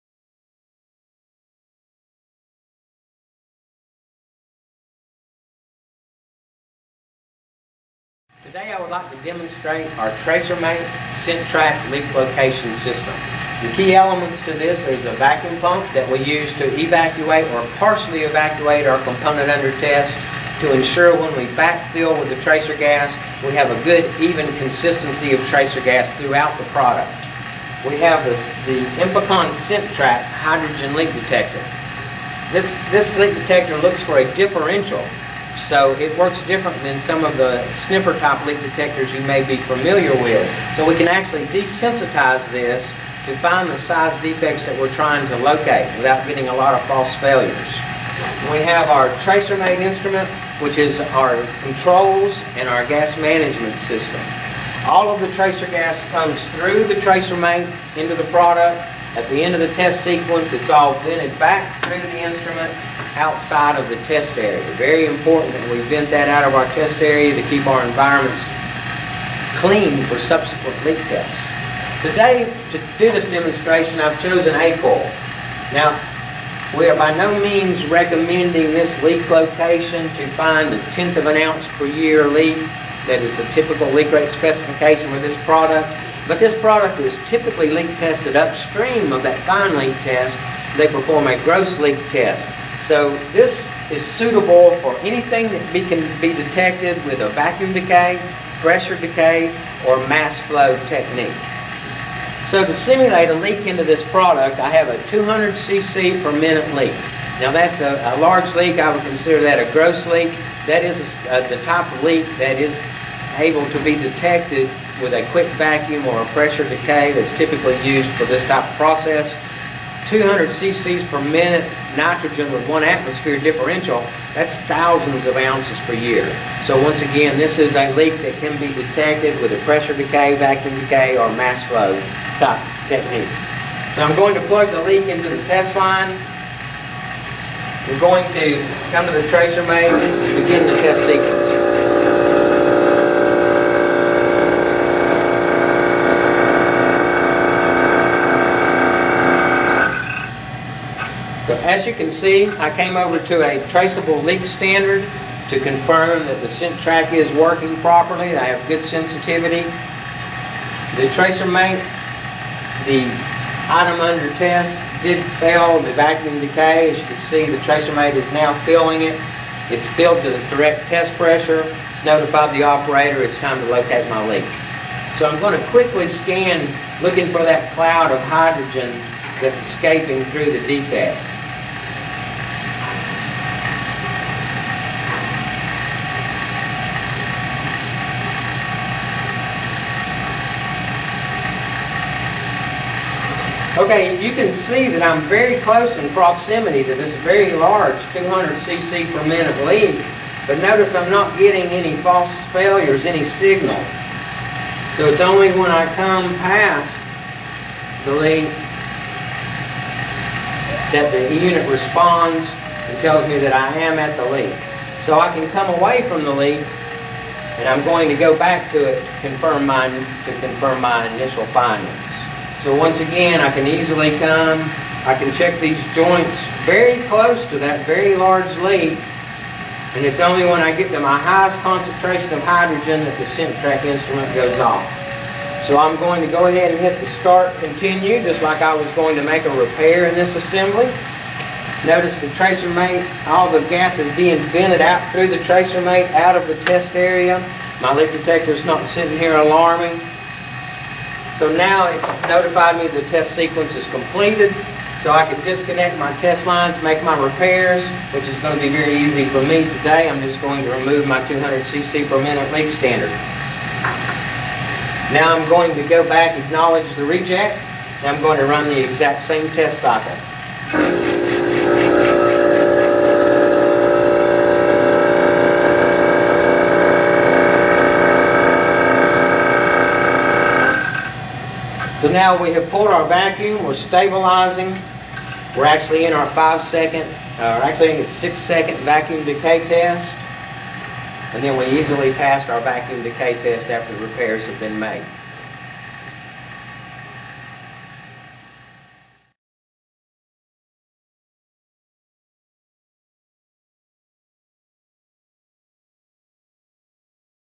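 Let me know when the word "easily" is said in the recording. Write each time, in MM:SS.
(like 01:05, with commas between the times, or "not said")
03:43, 04:51.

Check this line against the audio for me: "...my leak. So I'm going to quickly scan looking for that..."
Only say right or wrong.
right.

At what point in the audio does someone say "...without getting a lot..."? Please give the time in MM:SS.
00:45.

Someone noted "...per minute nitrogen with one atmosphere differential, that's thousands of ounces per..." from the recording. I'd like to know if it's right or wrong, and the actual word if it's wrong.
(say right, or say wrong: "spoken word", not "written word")
right.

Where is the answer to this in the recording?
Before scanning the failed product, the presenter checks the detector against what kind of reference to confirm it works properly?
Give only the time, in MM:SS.
02:33.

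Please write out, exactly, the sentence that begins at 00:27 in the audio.
We have this, the INFICON Sentrac hydrogen leak detector.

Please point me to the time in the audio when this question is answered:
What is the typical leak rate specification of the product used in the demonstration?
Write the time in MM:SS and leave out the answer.
01:20.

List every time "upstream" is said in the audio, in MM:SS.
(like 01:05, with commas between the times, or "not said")
01:28.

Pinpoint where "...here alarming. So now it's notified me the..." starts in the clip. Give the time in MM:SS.
04:09.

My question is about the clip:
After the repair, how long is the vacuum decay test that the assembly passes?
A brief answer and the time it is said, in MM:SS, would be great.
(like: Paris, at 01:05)
6 seconds, at 04:48.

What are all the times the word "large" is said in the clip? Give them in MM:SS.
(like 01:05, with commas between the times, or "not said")
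01:48, 03:17, 03:48.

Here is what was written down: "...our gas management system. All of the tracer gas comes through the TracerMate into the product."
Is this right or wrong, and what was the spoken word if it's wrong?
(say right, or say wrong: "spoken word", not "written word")
right.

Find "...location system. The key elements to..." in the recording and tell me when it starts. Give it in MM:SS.
00:12.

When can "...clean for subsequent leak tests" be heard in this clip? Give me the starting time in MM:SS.
01:09.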